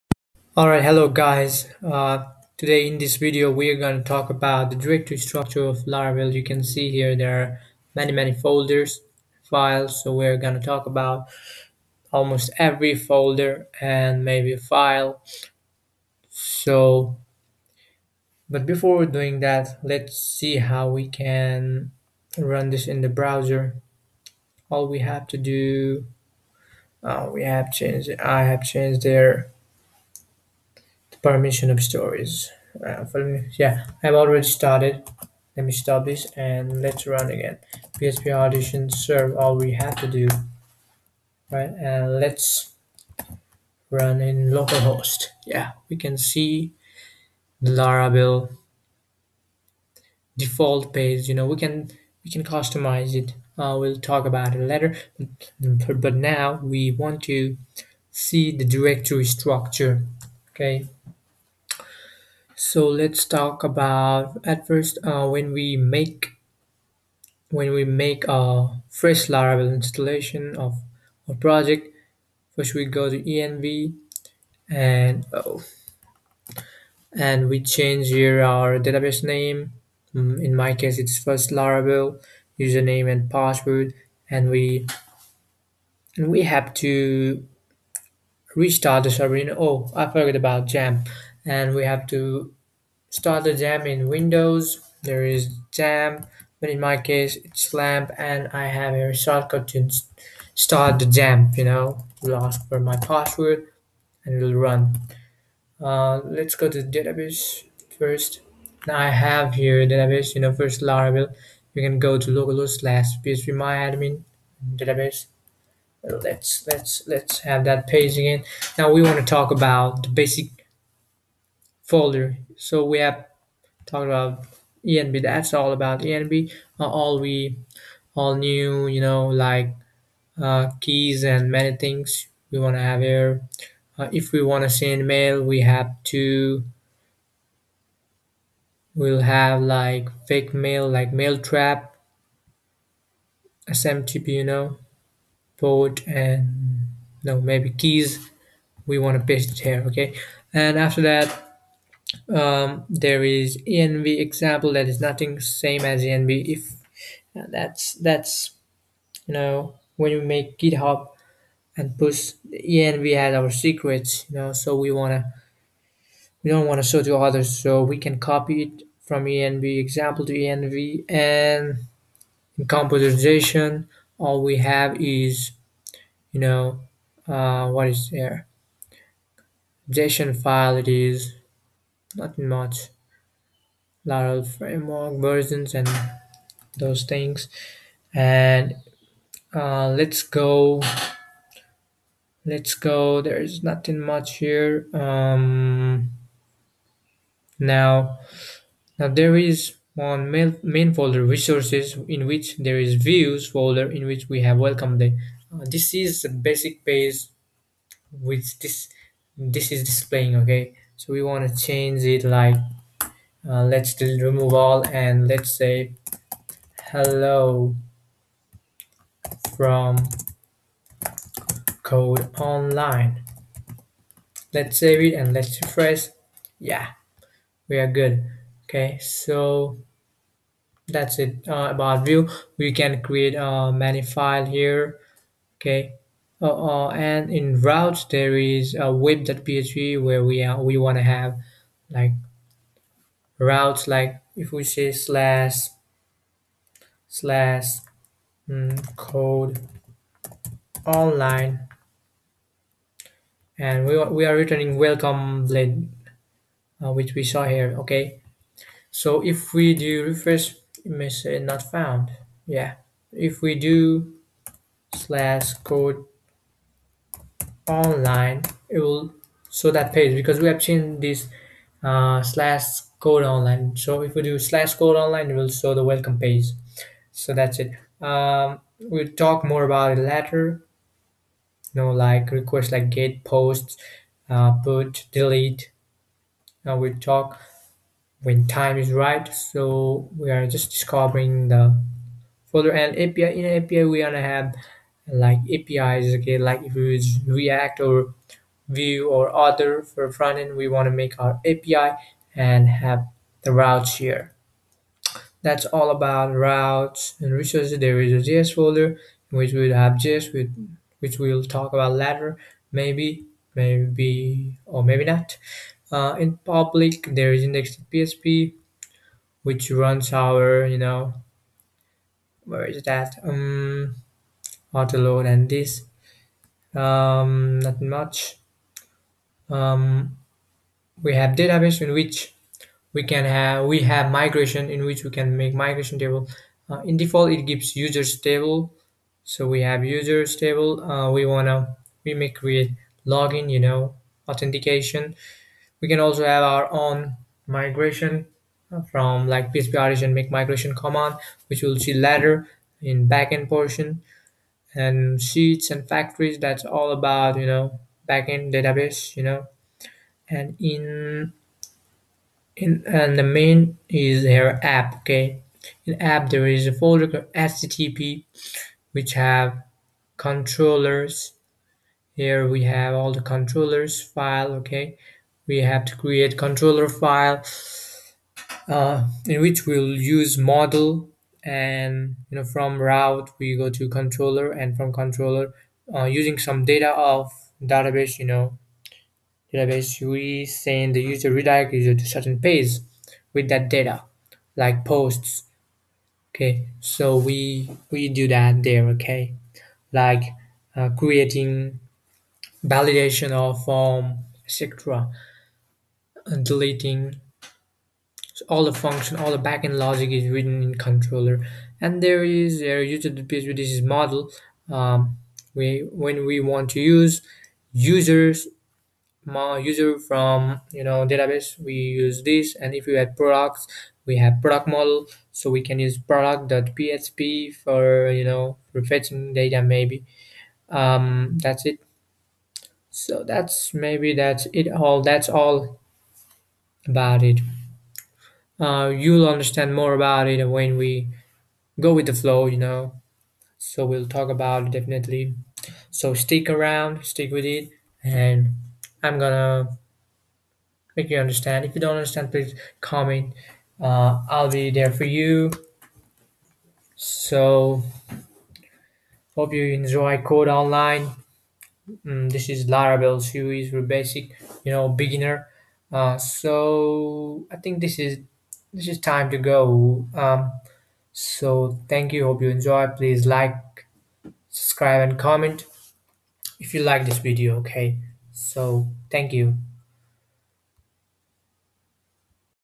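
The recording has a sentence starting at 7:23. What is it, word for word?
So we'll talk about it definitely.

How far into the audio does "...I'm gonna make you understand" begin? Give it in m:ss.
7:29.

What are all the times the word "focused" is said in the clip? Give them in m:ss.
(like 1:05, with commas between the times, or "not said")
not said.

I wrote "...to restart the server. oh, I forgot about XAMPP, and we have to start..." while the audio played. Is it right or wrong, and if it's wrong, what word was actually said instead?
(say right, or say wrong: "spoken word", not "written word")
right.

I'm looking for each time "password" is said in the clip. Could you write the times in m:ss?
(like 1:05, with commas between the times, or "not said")
1:23, 1:42.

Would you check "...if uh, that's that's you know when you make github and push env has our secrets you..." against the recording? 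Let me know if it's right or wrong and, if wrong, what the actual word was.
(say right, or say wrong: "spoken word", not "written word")
right.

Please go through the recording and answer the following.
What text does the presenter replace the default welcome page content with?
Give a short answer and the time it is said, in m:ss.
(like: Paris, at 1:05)
hello from code online, at 3:36.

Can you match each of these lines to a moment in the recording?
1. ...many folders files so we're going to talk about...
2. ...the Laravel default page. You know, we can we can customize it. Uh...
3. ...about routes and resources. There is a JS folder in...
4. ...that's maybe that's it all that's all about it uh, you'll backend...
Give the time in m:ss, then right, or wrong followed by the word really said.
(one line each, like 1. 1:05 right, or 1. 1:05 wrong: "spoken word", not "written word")
1. 0:08 right
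2. 0:47 right
3. 5:05 right
4. 7:13 wrong: "understand", not "backend".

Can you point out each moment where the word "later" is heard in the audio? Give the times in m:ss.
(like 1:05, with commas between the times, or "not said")
0:54, 4:40, 5:11, 5:51.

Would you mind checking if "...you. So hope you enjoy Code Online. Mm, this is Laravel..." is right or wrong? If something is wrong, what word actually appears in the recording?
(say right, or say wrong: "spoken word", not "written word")
right.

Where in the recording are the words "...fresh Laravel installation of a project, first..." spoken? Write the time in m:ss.
1:08.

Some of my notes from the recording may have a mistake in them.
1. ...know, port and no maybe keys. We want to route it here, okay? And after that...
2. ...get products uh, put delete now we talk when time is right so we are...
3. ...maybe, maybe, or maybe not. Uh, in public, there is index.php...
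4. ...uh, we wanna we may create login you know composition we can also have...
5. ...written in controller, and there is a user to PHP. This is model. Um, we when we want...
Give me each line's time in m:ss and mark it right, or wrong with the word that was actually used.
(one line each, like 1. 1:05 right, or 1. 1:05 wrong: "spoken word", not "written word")
1. 2:24 wrong: "paste", not "route"
2. 4:42 wrong: "posts", not "products"
3. 5:12 right
4. 5:40 wrong: "authentication", not "composition"
5. 6:50 right.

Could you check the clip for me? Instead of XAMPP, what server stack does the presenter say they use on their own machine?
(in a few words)
lamp.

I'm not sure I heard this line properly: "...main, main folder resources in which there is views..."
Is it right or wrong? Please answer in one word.
right.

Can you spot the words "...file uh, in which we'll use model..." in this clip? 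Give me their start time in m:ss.
6:16.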